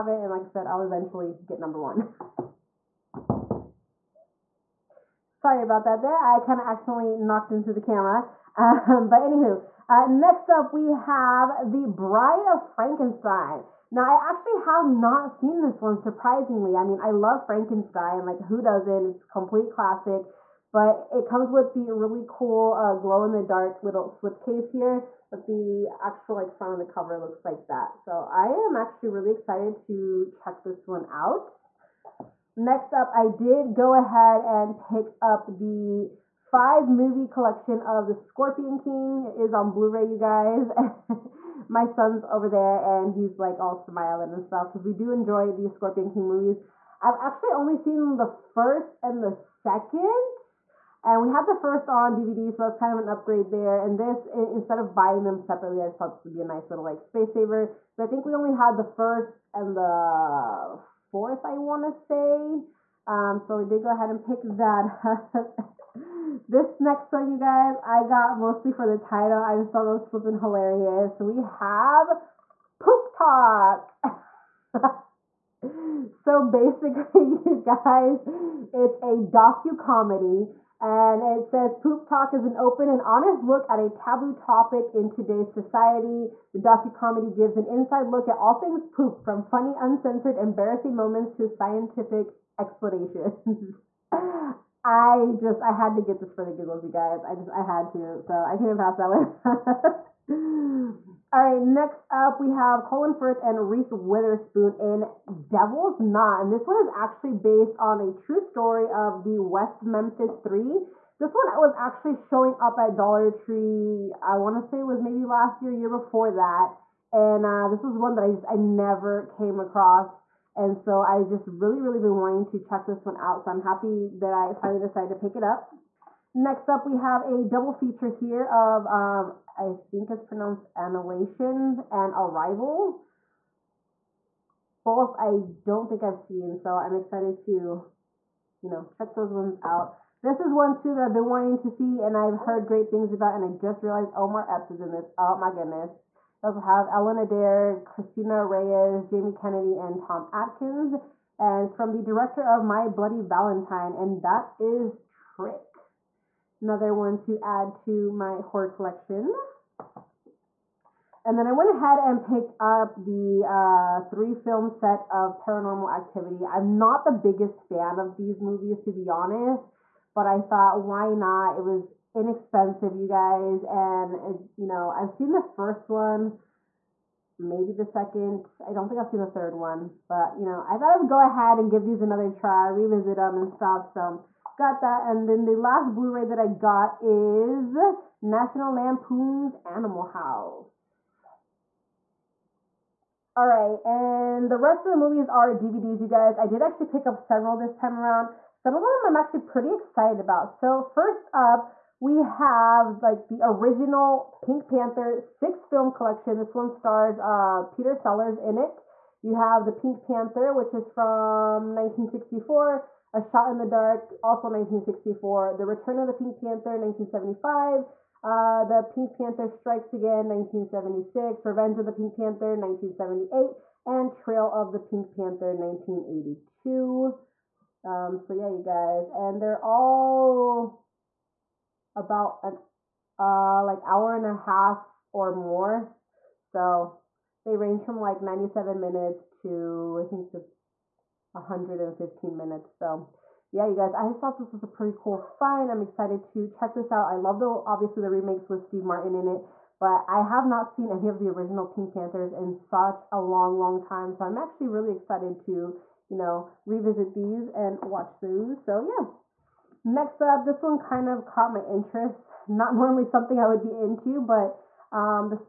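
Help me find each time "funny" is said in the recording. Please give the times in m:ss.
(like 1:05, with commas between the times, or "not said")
1:29.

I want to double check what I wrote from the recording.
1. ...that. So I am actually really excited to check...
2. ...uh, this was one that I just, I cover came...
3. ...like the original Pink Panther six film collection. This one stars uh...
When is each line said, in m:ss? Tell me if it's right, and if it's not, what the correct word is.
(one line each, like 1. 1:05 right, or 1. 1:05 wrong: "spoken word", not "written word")
1. 0:27 right
2. 1:57 wrong: "never", not "cover"
3. 3:23 right.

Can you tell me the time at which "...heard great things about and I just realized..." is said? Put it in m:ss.
2:22.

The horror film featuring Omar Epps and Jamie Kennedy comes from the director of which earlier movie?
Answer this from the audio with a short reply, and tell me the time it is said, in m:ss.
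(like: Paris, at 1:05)
My Bloody Valentine, at 2:32.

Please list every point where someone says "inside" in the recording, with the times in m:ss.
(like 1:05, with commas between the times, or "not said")
1:27.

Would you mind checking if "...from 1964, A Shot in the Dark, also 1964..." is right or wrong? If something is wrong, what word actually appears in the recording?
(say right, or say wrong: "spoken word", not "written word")
right.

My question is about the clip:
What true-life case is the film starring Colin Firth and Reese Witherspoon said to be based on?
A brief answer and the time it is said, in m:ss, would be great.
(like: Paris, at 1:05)
West Memphis 3, at 1:49.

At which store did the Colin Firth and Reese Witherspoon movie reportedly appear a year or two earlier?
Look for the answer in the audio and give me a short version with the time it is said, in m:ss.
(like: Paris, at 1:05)
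Dollar Tree, at 1:52.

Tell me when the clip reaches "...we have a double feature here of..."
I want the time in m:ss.
2:06.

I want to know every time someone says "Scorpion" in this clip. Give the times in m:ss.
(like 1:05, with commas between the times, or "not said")
0:38, 0:45.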